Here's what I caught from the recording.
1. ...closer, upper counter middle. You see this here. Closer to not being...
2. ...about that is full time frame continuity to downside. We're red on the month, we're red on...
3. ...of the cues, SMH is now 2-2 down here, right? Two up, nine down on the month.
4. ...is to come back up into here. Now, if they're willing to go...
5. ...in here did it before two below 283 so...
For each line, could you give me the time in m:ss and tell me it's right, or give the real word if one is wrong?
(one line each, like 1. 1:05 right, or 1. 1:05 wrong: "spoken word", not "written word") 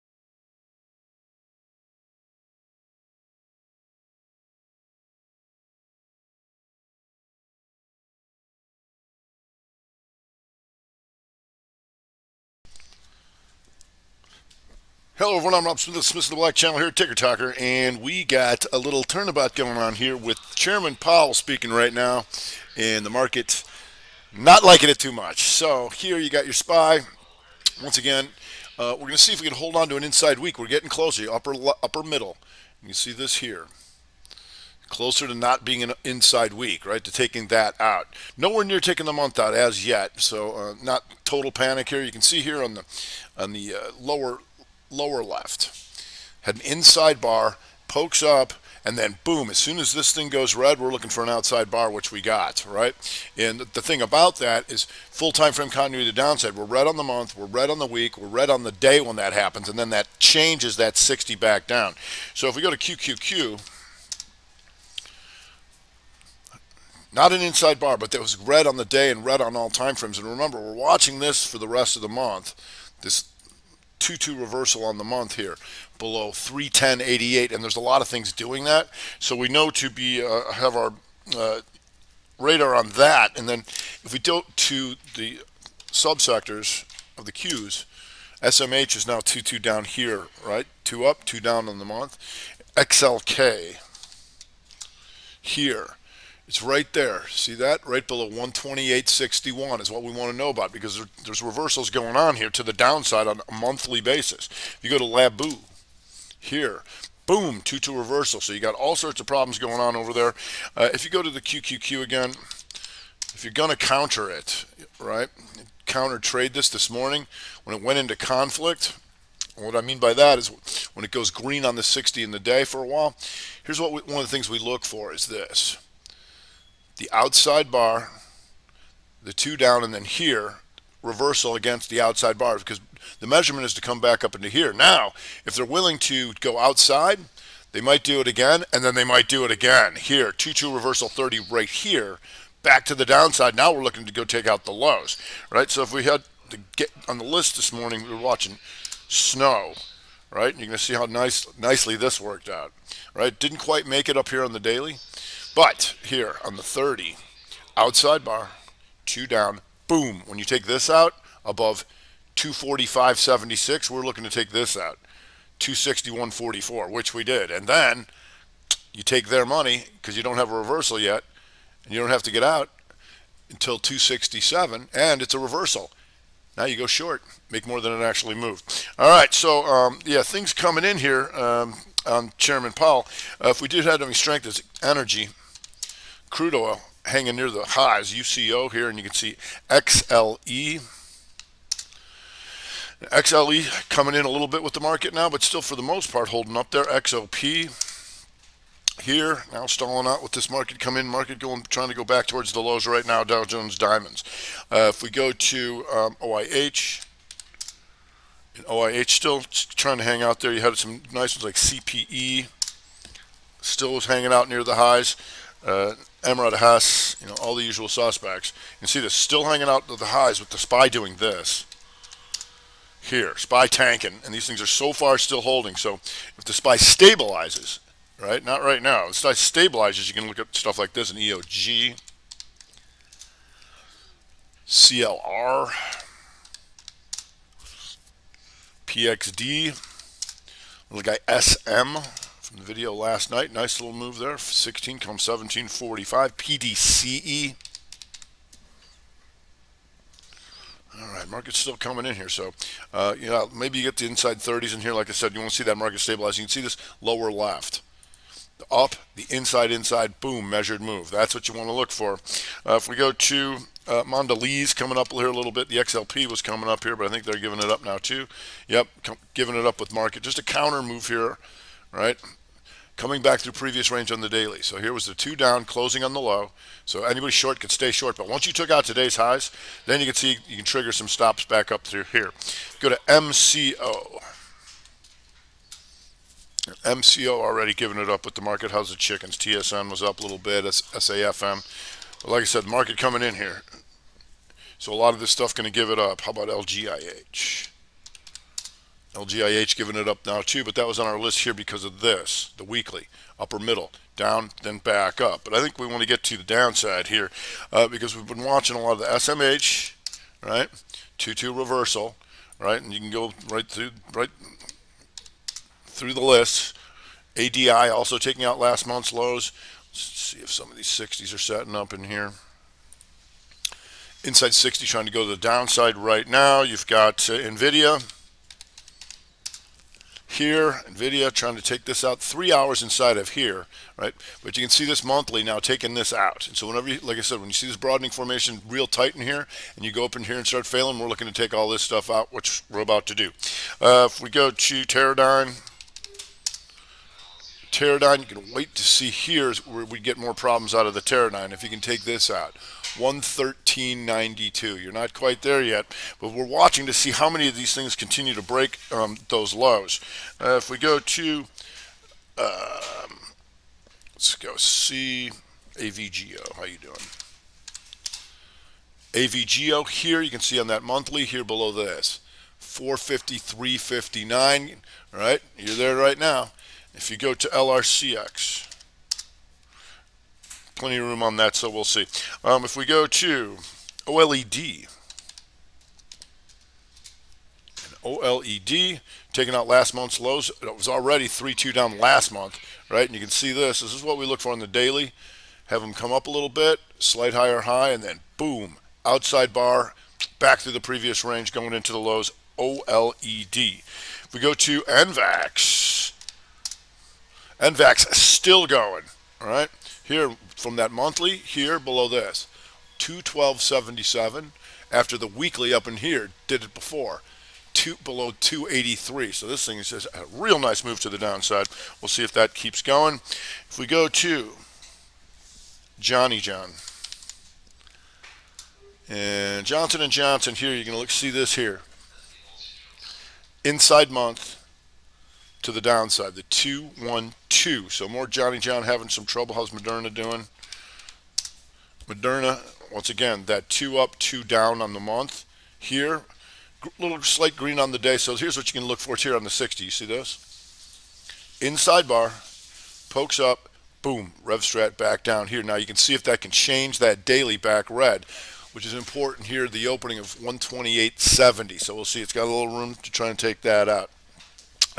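1. 0:30 wrong: "upper", not "counter"
2. 0:54 right
3. 1:27 wrong: "two", not "nine"
4. 2:13 right
5. 6:55 right.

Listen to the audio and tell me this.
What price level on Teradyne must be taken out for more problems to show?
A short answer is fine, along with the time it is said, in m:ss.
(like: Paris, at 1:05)
113.92, at 5:52.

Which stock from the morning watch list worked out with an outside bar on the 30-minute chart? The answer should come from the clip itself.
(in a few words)
SNOW.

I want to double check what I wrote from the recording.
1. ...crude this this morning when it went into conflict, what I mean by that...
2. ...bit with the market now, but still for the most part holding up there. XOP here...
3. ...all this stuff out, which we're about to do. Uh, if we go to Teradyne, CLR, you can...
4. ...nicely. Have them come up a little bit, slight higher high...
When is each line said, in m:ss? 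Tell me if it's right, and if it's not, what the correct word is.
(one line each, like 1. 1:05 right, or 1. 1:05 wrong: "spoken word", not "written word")
1. 1:56 wrong: "trade", not "crude"
2. 3:14 right
3. 5:41 wrong: "Teradyne", not "CLR"
4. 6:34 wrong: "daily", not "nicely".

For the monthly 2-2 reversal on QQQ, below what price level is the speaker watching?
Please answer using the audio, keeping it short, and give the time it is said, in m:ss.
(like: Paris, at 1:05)
310.88, at 1:16.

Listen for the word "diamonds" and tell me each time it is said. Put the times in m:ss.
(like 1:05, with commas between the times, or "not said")
3:23.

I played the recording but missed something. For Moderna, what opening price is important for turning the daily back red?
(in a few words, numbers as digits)
128.70.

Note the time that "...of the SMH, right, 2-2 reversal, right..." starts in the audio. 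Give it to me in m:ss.
5:08.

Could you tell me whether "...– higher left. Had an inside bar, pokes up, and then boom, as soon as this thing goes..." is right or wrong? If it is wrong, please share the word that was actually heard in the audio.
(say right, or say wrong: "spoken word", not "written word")
wrong: "lower", not "higher".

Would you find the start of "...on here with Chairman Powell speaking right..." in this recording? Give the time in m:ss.
0:19.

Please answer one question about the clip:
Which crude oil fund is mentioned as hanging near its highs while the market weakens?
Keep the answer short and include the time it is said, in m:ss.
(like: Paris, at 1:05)
UCO, at 3:08.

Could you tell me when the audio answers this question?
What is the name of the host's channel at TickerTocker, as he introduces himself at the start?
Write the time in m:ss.
0:16.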